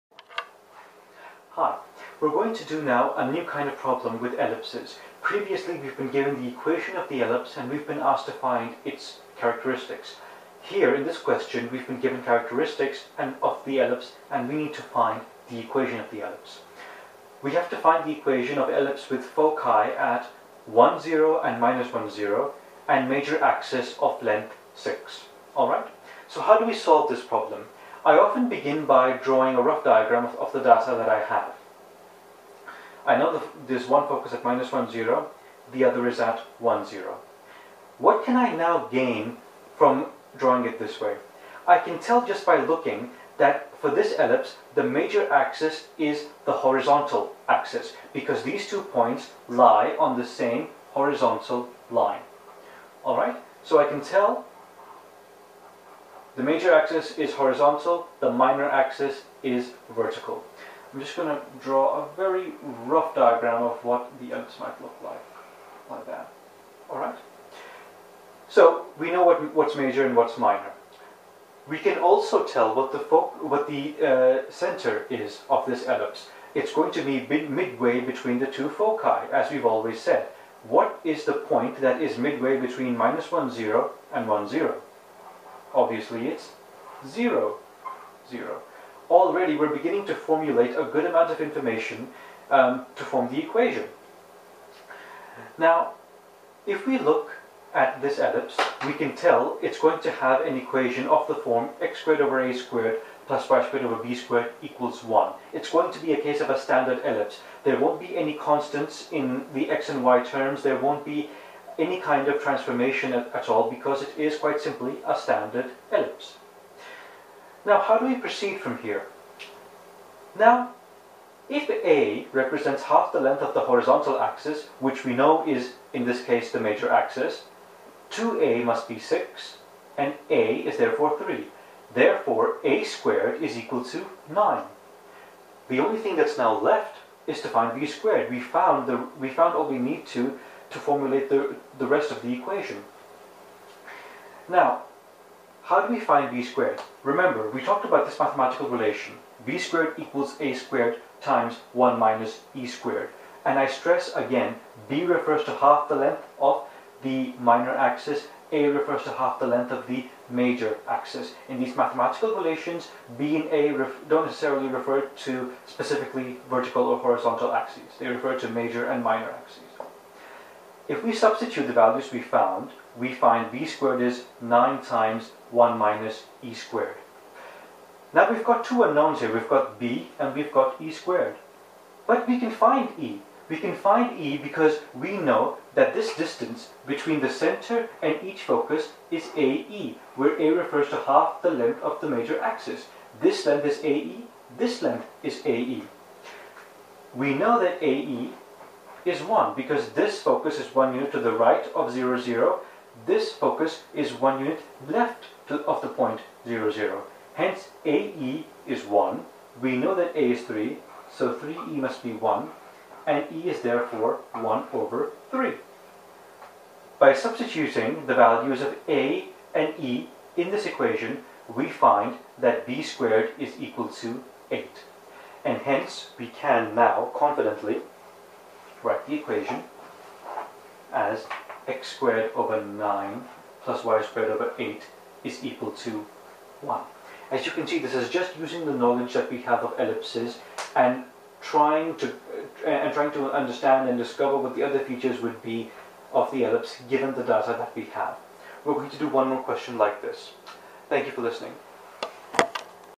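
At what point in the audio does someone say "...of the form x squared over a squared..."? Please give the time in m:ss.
1:41.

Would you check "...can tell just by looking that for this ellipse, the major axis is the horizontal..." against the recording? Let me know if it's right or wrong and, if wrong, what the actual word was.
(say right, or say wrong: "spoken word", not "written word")
right.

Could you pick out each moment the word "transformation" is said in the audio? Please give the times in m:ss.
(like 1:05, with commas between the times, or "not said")
1:52.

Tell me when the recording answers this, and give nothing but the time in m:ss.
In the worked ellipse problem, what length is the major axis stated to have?
0:23.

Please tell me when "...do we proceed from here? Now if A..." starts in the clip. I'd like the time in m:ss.
1:57.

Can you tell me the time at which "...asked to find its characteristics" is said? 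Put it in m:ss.
0:07.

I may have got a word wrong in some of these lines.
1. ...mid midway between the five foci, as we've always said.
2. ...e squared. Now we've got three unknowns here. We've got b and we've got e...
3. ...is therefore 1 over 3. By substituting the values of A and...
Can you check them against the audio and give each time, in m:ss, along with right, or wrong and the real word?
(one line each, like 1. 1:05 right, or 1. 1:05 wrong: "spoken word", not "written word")
1. 1:17 wrong: "two", not "five"
2. 2:56 wrong: "two", not "three"
3. 3:33 right.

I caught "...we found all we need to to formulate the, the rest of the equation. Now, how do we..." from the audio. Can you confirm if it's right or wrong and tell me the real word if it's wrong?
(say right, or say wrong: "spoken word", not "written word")
right.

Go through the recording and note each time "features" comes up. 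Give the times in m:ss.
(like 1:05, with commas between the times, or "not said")
4:04.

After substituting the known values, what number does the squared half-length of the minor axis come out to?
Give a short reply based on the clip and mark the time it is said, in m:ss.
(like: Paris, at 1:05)
8, at 3:42.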